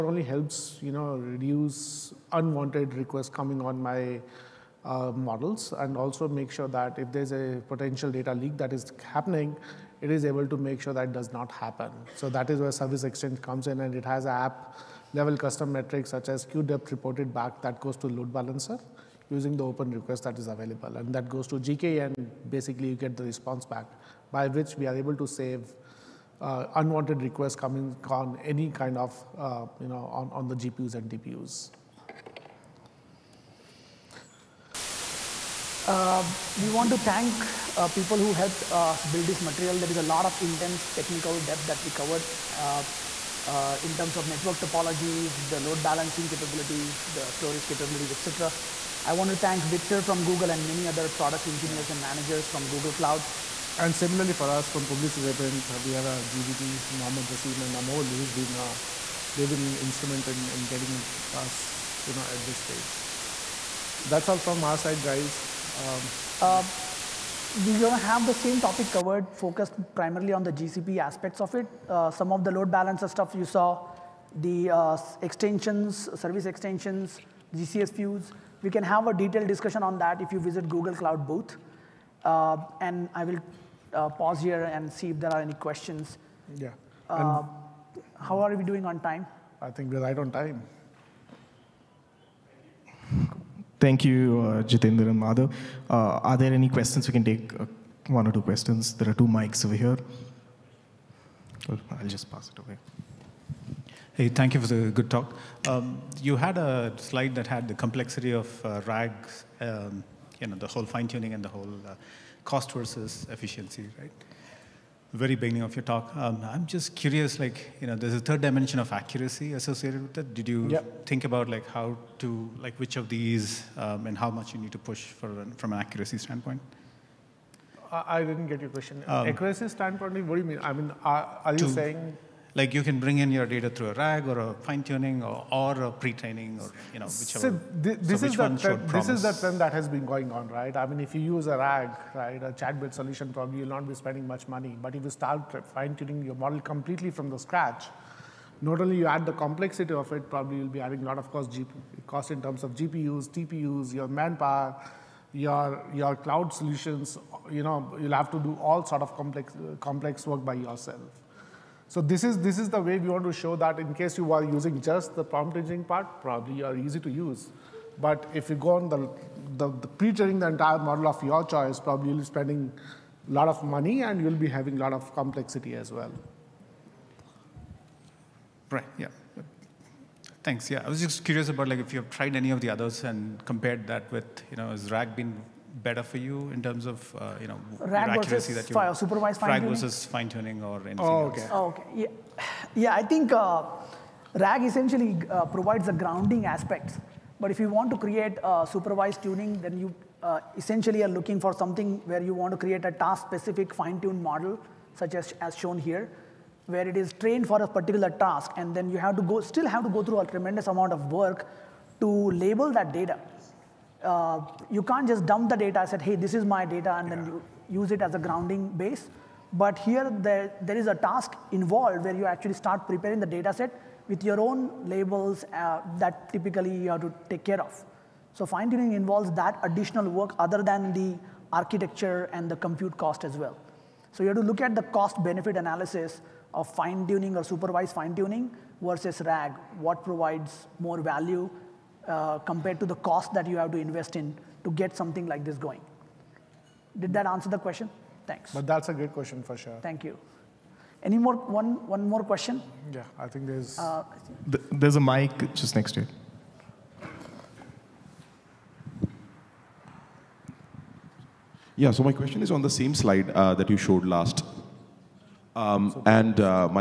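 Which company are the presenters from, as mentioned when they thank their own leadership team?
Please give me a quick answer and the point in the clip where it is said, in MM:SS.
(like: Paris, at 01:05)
Publicis Sapient, at 00:54.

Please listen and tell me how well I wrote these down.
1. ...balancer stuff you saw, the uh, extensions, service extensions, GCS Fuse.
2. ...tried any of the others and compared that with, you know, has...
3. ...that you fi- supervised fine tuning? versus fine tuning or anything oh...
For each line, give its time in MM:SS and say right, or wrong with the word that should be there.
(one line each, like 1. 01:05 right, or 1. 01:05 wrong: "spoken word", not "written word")
1. 01:12 right
2. 03:02 right
3. 03:08 right.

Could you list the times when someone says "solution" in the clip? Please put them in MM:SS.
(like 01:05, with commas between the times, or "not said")
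02:22, 02:36.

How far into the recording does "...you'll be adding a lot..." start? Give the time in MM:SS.
02:30.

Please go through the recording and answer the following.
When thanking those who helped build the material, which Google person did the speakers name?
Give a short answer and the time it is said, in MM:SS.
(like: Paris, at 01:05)
Victor, at 00:49.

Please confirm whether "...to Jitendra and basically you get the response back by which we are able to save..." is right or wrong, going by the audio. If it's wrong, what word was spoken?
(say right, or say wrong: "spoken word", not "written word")
wrong: "GKE", not "Jitendra".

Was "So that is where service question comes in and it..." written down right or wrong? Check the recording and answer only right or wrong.
wrong.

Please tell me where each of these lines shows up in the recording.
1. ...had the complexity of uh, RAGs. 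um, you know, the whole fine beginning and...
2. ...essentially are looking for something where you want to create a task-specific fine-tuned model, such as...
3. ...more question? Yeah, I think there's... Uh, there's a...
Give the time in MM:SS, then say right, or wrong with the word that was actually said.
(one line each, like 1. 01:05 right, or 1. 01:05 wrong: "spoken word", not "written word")
1. 01:47 wrong: "tuning", not "beginning"
2. 03:20 right
3. 04:12 right.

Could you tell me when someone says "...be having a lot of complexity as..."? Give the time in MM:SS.
02:54.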